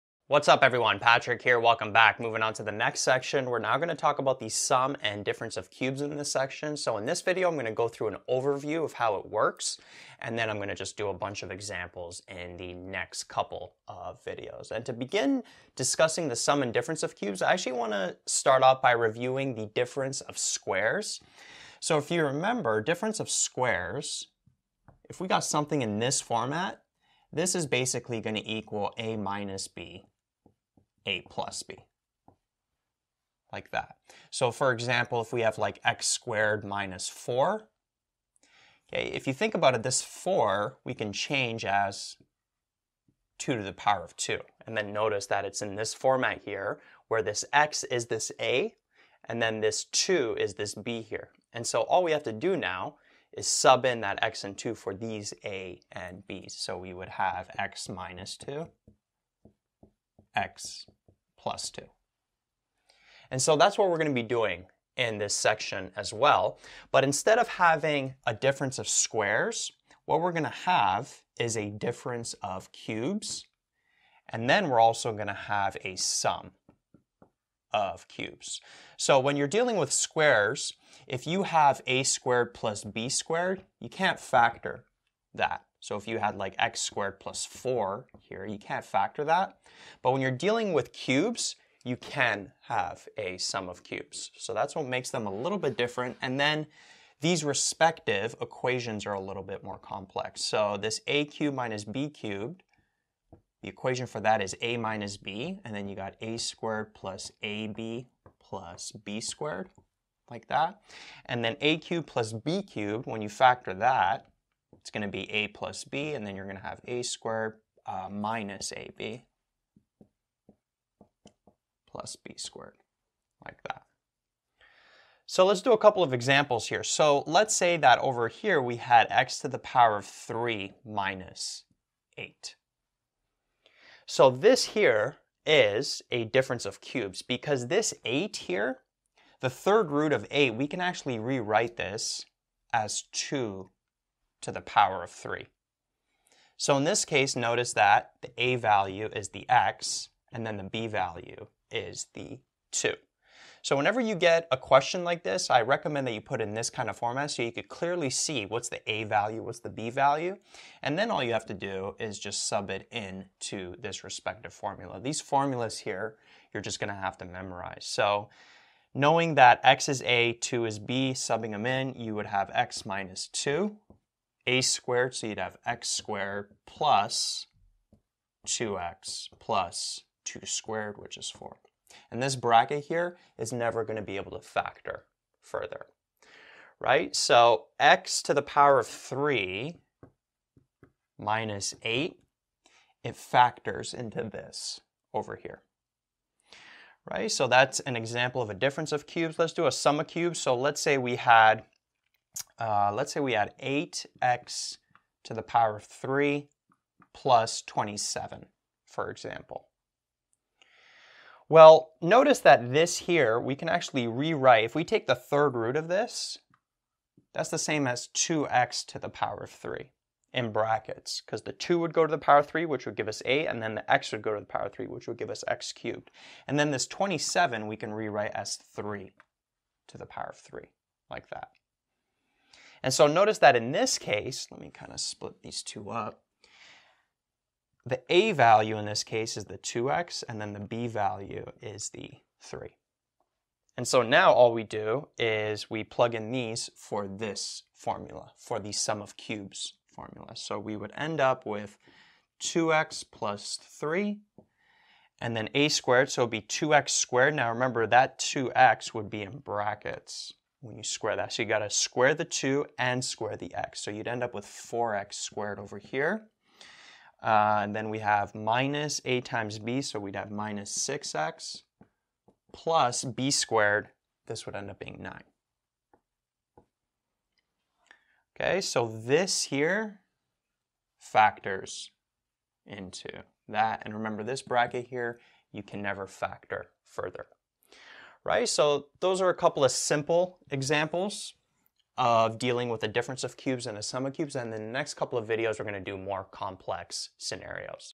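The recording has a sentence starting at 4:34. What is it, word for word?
This would end up being 9.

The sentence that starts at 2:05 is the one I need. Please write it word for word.
So let's do a couple of examples here.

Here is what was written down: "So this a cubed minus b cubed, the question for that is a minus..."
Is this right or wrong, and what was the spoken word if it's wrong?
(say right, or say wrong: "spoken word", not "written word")
wrong: "equation", not "question".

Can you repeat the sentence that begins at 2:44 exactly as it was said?
These formulas here, you're just gonna have to memorize.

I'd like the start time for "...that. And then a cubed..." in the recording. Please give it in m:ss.
1:50.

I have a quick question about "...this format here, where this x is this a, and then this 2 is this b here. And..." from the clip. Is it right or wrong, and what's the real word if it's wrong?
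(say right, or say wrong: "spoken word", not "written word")
right.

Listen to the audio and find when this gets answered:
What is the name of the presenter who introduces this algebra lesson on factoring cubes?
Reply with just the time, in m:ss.
0:00.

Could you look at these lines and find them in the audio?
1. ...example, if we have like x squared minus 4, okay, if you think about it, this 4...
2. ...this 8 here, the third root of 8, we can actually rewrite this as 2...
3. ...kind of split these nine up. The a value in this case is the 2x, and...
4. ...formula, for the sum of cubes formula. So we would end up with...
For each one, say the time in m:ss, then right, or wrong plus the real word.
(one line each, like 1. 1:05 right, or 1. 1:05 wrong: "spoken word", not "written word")
1. 0:34 right
2. 2:17 right
3. 3:54 wrong: "two", not "nine"
4. 4:07 right.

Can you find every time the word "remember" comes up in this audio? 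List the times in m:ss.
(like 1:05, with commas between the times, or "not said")
0:22, 4:17, 4:43.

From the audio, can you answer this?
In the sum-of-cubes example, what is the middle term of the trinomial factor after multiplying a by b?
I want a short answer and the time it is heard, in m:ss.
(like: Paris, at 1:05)
minus 6x, at 4:30.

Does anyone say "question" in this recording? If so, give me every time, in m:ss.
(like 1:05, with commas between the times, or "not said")
2:34.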